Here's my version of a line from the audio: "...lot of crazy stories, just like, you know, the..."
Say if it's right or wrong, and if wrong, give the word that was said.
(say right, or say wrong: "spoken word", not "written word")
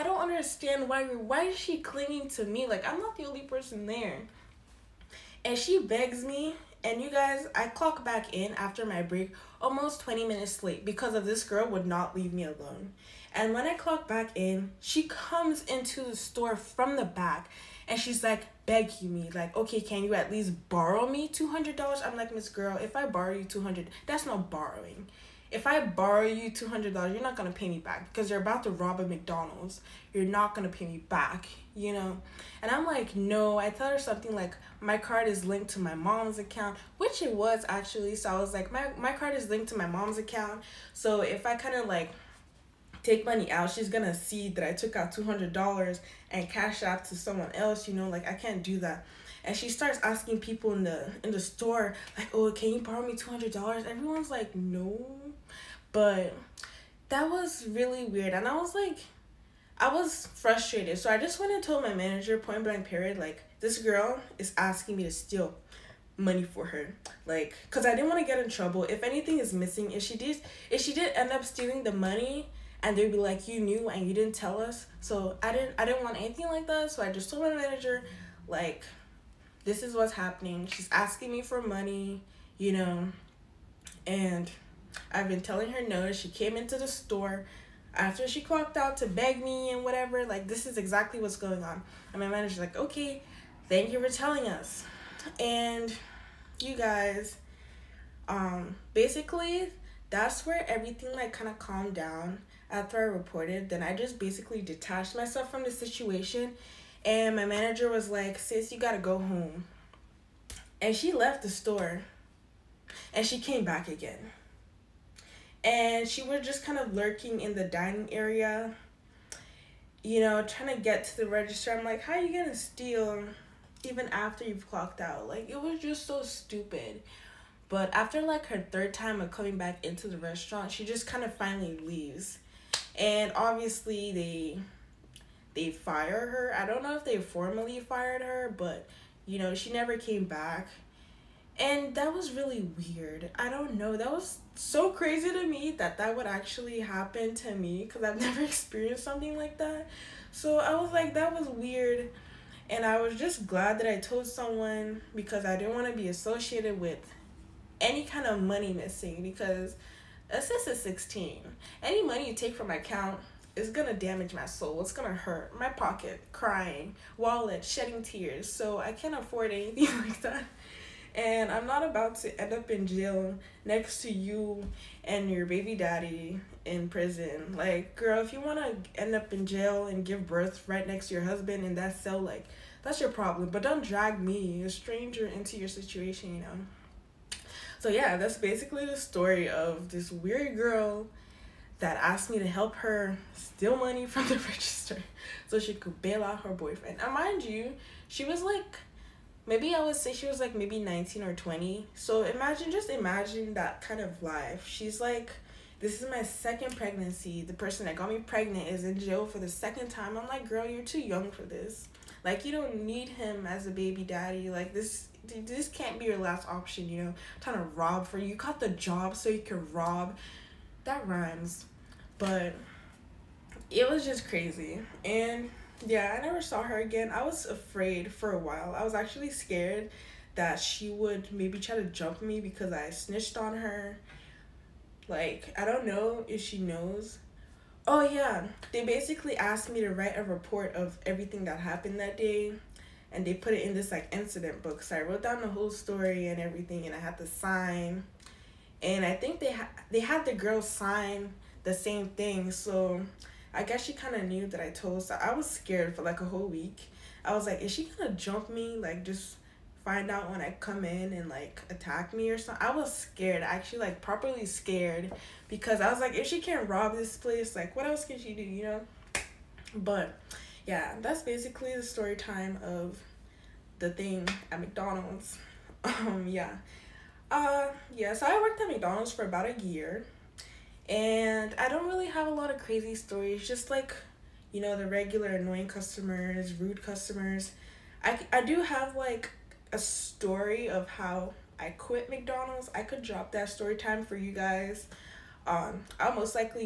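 right.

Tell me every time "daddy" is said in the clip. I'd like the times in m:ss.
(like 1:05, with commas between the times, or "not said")
2:55, 3:34.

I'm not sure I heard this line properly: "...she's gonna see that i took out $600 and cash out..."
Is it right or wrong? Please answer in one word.
wrong.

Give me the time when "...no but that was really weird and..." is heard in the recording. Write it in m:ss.
0:54.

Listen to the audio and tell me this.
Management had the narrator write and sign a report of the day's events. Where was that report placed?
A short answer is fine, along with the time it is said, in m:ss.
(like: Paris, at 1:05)
Incident book, at 4:04.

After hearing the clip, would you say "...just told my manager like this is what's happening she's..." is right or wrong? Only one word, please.
right.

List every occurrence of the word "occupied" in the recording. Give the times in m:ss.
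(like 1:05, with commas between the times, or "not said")
not said.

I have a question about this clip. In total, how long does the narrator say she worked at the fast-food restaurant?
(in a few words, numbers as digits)
About a year.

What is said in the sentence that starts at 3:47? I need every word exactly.
I was afraid for a while.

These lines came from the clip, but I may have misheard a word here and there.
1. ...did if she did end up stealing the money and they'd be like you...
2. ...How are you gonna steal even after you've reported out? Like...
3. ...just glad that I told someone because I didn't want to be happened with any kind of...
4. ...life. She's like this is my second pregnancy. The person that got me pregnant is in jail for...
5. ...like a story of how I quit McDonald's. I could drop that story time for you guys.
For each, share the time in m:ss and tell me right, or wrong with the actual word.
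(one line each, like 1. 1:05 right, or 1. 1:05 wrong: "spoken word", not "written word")
1. 1:10 right
2. 2:02 wrong: "clocked", not "reported"
3. 2:33 wrong: "associated", not "happened"
4. 3:24 right
5. 4:48 right.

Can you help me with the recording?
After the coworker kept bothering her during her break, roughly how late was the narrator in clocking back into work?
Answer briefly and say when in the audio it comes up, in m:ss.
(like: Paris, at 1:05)
20 minutes, at 0:10.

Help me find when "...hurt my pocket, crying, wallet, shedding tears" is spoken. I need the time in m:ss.
2:45.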